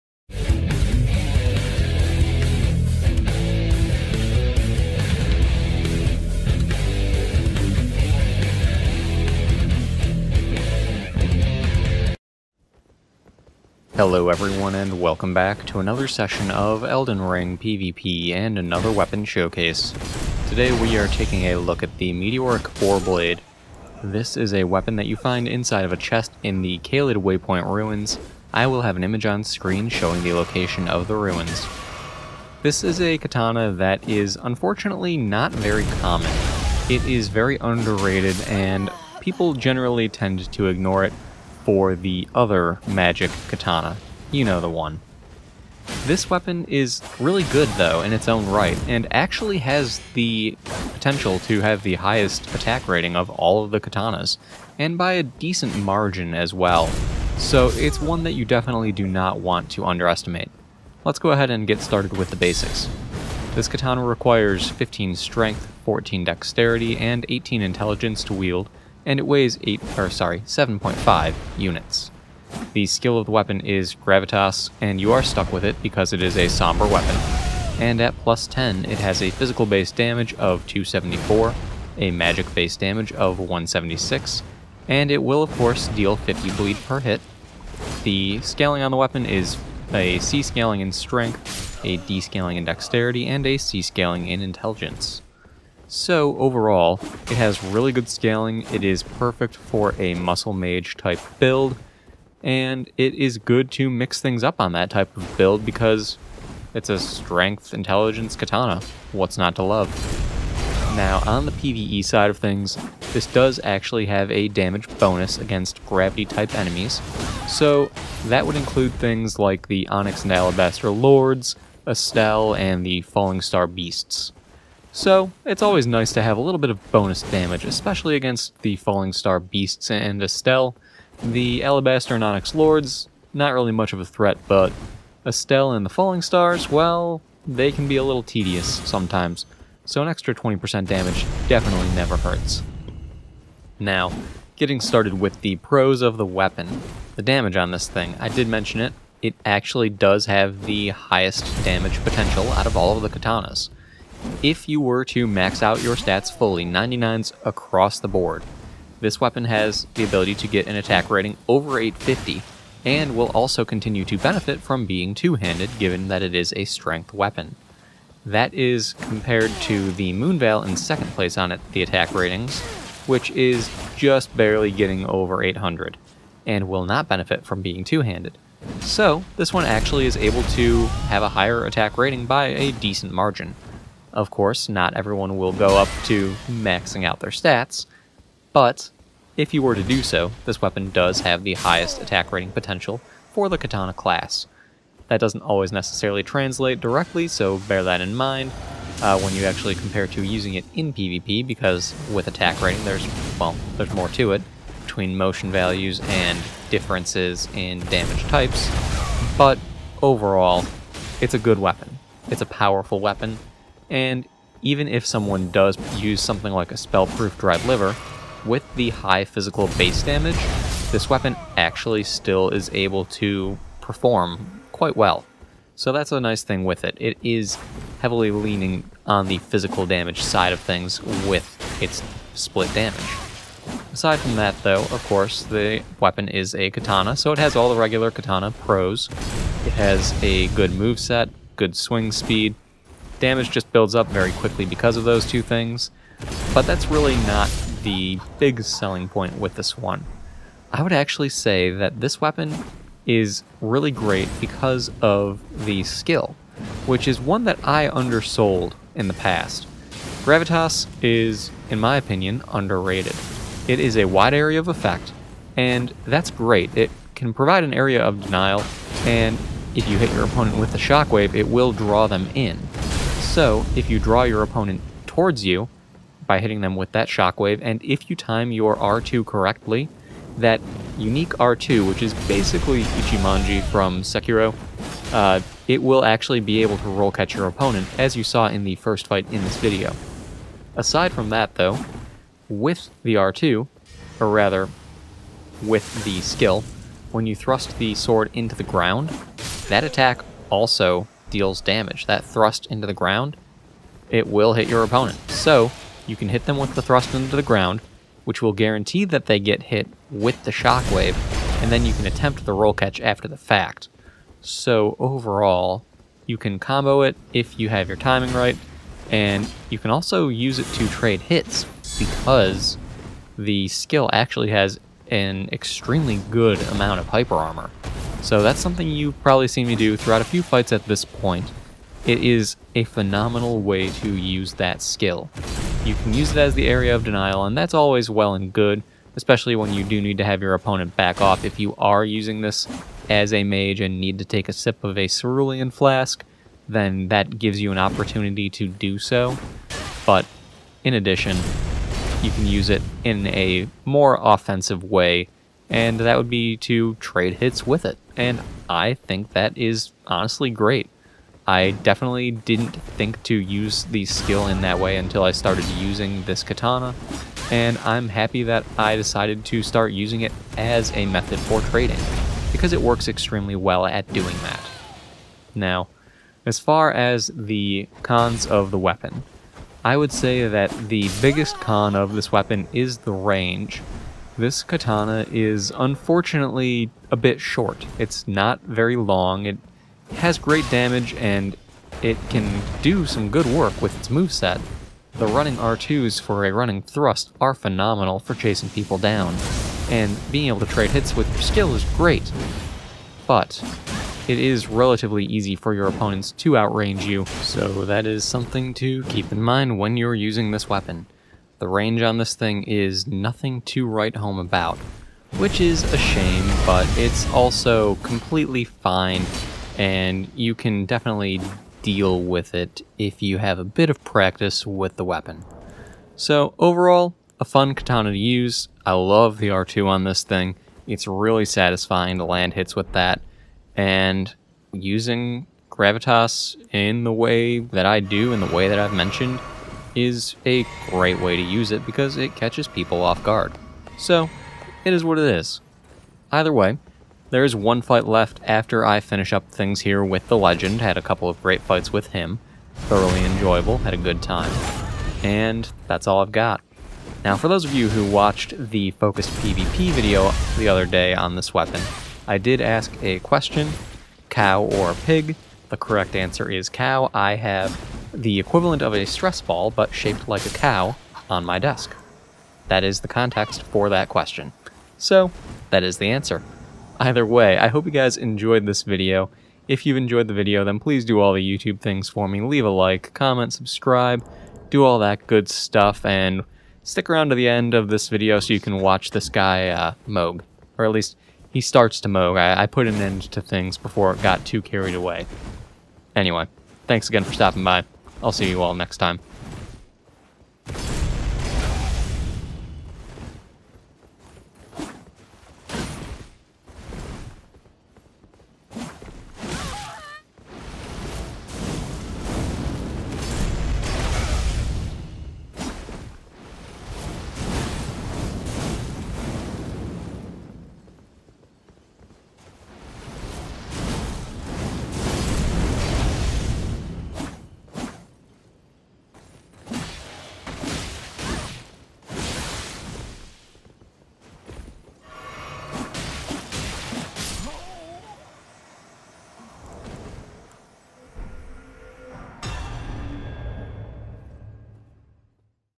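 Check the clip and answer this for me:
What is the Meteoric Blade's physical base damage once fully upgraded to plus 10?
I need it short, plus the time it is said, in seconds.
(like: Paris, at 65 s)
274, at 80 s.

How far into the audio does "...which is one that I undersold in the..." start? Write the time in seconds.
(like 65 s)
256 s.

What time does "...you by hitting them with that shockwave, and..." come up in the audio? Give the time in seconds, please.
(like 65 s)
275 s.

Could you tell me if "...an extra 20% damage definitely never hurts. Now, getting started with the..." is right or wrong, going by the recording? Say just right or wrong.
right.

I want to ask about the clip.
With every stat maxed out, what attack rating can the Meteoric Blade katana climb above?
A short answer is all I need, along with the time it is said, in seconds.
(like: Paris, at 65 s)
850, at 161 s.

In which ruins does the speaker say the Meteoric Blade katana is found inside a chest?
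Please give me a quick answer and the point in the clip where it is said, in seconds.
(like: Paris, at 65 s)
Caelid Waypoint ruins, at 26 s.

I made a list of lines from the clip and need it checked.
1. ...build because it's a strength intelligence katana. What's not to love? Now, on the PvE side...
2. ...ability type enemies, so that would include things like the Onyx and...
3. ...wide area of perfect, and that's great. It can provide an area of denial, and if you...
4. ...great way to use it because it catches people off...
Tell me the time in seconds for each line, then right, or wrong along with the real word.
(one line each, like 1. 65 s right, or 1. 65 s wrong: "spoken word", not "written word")
1. 105 s right
2. 115 s wrong: "gravity", not "ability"
3. 264 s wrong: "effect", not "perfect"
4. 440 s right.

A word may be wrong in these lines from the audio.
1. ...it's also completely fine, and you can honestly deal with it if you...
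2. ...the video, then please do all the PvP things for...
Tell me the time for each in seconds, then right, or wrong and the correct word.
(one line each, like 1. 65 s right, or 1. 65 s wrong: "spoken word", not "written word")
1. 416 s wrong: "definitely", not "honestly"
2. 480 s wrong: "YouTube", not "PvP".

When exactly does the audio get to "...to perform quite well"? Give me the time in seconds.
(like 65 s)
223 s.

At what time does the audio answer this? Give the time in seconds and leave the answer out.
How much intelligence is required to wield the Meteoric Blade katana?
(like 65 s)
67 s.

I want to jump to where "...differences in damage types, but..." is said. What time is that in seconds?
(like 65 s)
206 s.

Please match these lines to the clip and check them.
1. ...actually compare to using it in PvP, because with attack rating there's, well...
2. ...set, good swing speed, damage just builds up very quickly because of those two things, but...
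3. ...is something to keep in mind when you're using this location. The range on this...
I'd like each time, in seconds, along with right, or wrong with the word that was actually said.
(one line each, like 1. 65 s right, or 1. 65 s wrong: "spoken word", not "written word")
1. 199 s right
2. 240 s right
3. 408 s wrong: "weapon", not "location".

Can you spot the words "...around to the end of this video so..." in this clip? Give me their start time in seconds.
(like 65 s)
487 s.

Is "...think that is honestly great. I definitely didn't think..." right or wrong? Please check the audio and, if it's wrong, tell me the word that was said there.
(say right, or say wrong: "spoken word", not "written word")
right.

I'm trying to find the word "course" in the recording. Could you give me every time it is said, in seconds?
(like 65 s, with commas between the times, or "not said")
85 s, 184 s, 235 s.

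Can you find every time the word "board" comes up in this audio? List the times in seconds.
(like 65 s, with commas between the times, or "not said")
158 s.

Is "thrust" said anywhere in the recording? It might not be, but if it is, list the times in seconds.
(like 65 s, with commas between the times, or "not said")
297 s, 302 s, 306 s, 396 s.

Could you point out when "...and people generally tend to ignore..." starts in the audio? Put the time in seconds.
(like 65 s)
38 s.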